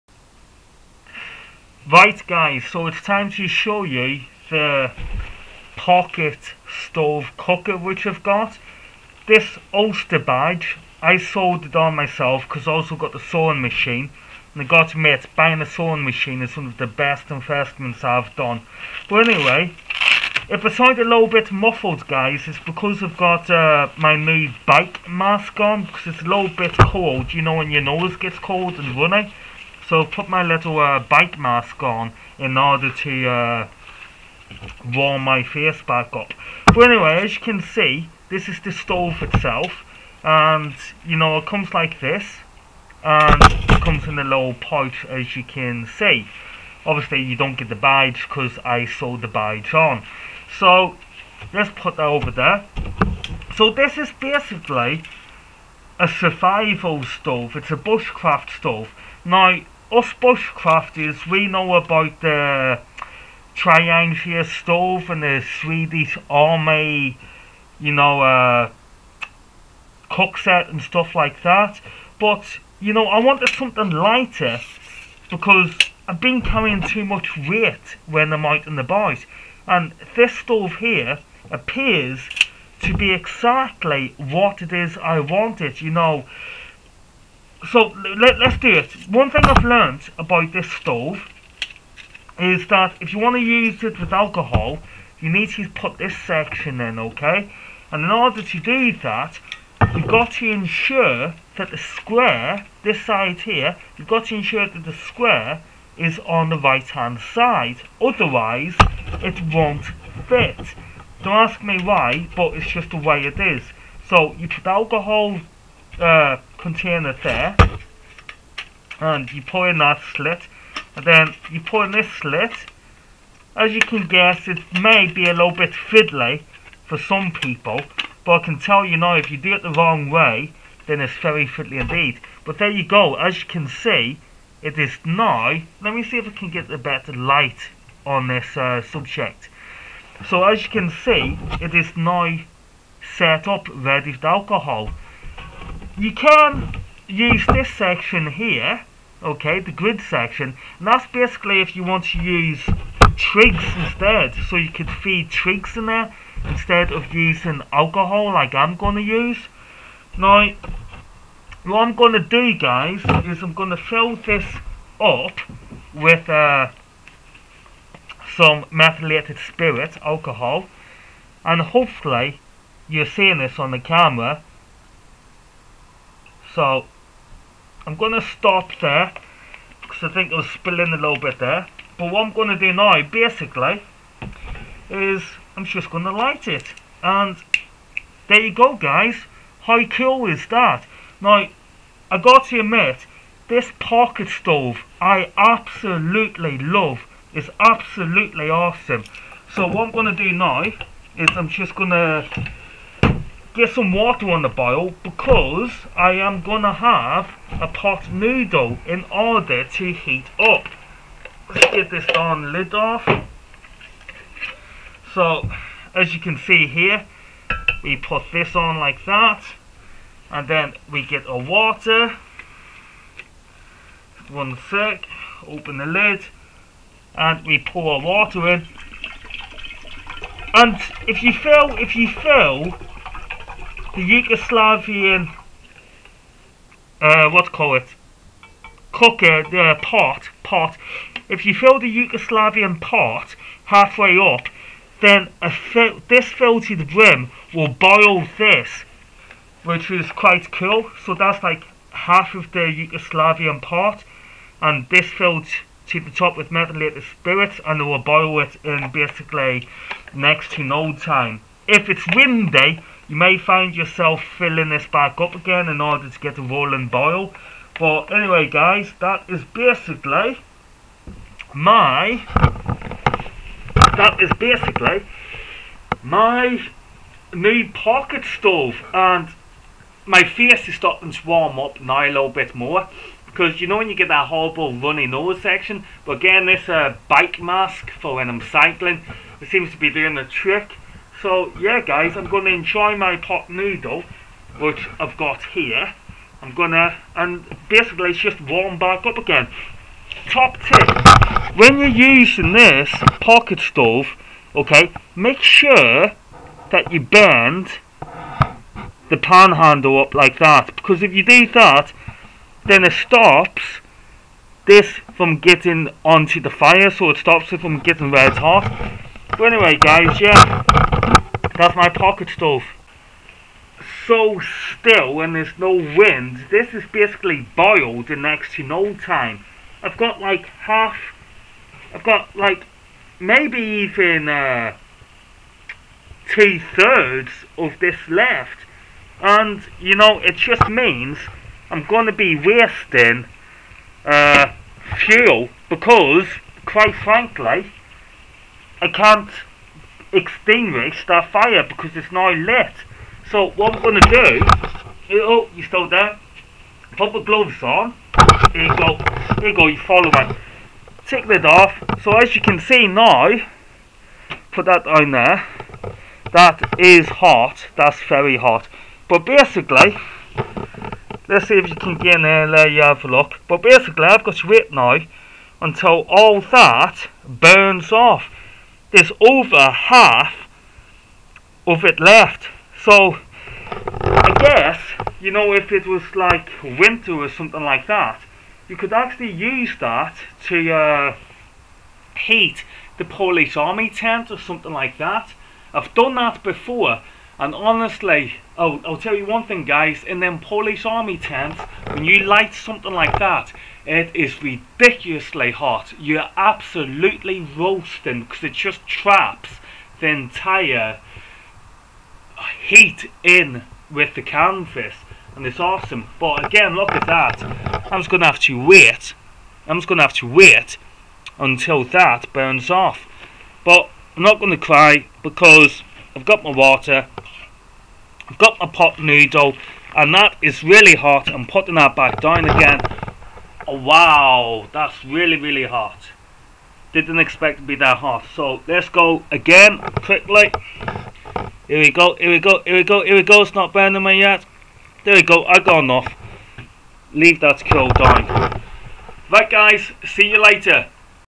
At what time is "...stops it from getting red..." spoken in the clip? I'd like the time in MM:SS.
05:17.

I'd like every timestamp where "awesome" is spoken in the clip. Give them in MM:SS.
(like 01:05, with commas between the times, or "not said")
03:18, 06:55.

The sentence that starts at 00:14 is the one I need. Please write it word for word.
And I got to admit, buying a sewing machine is one of the best investments I've done.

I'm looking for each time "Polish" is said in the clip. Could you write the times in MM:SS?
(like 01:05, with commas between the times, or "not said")
06:33, 06:40.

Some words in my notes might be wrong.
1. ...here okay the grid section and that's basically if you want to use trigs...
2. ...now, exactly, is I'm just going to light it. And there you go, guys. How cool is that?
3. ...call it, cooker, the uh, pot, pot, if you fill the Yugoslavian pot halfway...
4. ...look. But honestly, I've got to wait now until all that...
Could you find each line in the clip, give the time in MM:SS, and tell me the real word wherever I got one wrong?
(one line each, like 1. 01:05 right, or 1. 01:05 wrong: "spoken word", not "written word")
1. 02:28 right
2. 03:02 wrong: "basically", not "exactly"
3. 03:57 right
4. 06:13 wrong: "basically", not "honestly".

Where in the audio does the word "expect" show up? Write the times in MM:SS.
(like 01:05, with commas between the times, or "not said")
07:17.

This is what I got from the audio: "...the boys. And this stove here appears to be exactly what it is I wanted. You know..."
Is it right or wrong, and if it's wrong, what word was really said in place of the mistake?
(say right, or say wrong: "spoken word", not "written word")
right.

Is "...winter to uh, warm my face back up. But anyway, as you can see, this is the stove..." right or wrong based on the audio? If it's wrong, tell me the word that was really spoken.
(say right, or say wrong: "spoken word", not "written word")
wrong: "order", not "winter".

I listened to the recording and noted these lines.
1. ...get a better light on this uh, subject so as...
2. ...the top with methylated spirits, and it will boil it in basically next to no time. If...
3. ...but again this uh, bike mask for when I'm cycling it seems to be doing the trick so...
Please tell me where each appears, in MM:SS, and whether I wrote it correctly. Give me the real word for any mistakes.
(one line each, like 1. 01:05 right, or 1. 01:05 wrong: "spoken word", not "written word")
1. 02:16 right
2. 04:15 right
3. 04:46 right.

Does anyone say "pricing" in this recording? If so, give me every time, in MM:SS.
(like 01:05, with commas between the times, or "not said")
not said.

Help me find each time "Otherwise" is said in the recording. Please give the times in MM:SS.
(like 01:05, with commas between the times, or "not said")
01:48.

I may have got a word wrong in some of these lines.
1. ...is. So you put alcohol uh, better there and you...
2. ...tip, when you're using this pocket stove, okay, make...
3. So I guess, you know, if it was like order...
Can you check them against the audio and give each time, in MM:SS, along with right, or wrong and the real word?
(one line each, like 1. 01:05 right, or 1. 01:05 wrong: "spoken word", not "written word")
1. 01:53 wrong: "container", not "better"
2. 05:00 right
3. 06:22 wrong: "winter", not "order".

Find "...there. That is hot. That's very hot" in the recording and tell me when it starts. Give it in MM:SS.
06:05.